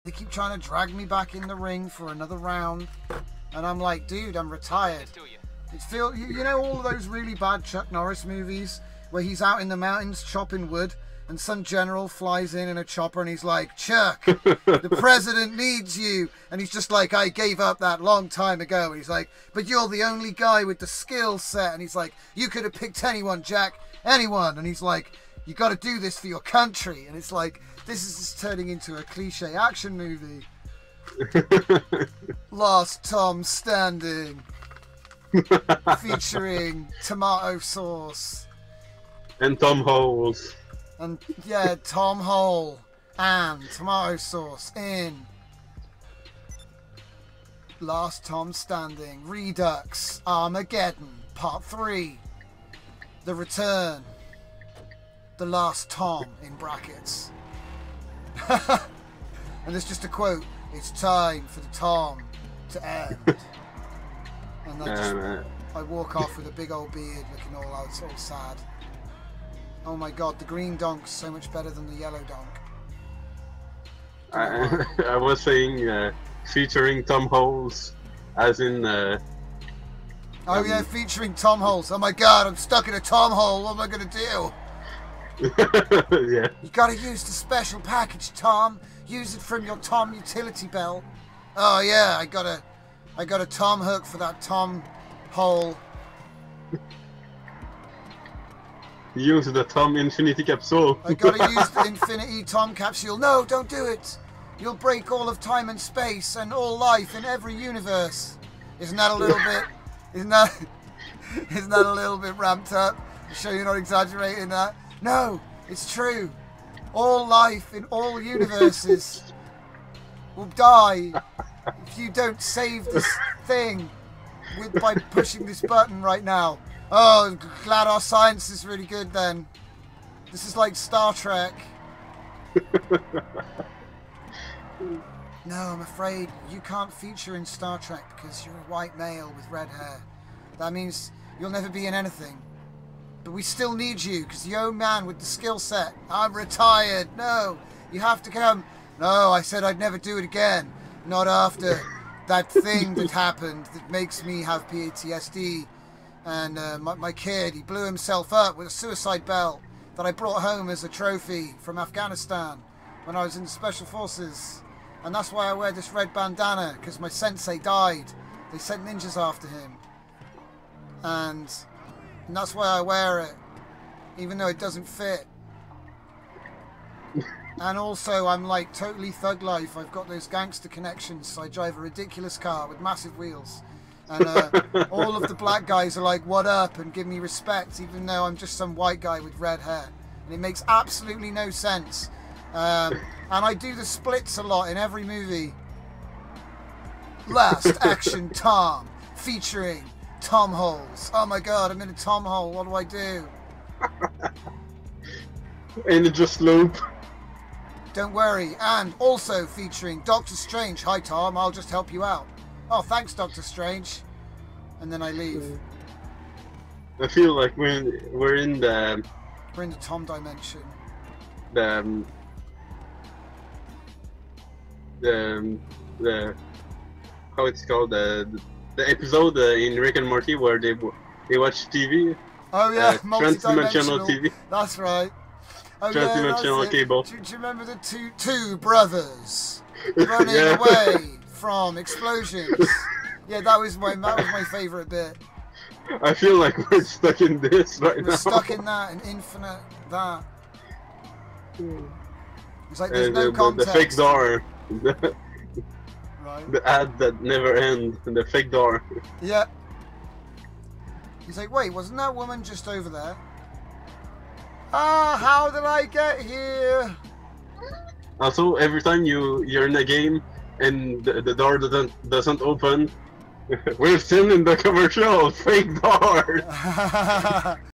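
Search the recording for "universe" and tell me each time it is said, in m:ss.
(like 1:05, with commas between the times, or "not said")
1:47, 1:58.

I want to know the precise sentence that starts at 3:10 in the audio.
And it makes absolutely no sense.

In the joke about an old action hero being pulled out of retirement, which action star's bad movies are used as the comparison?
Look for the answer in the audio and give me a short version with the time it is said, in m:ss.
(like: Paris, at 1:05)
Chuck Norris, at 0:07.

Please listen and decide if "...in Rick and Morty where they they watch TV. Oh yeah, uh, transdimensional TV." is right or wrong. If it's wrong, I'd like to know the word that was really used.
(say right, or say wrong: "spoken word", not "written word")
right.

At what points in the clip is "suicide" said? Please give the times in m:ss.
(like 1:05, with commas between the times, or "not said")
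2:38.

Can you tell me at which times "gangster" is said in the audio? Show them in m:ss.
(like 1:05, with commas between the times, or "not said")
3:00.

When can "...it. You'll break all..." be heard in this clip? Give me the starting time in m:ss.
1:43.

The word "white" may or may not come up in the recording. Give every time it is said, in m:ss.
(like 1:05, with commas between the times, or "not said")
2:18, 3:08.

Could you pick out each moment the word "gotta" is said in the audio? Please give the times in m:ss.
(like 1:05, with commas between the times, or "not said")
1:26, 1:41.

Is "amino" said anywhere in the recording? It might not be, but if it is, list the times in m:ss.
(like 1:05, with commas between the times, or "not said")
not said.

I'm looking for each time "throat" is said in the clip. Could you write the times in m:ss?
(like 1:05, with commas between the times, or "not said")
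not said.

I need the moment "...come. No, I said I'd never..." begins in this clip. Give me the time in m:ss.
2:28.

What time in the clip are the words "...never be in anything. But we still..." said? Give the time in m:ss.
2:21.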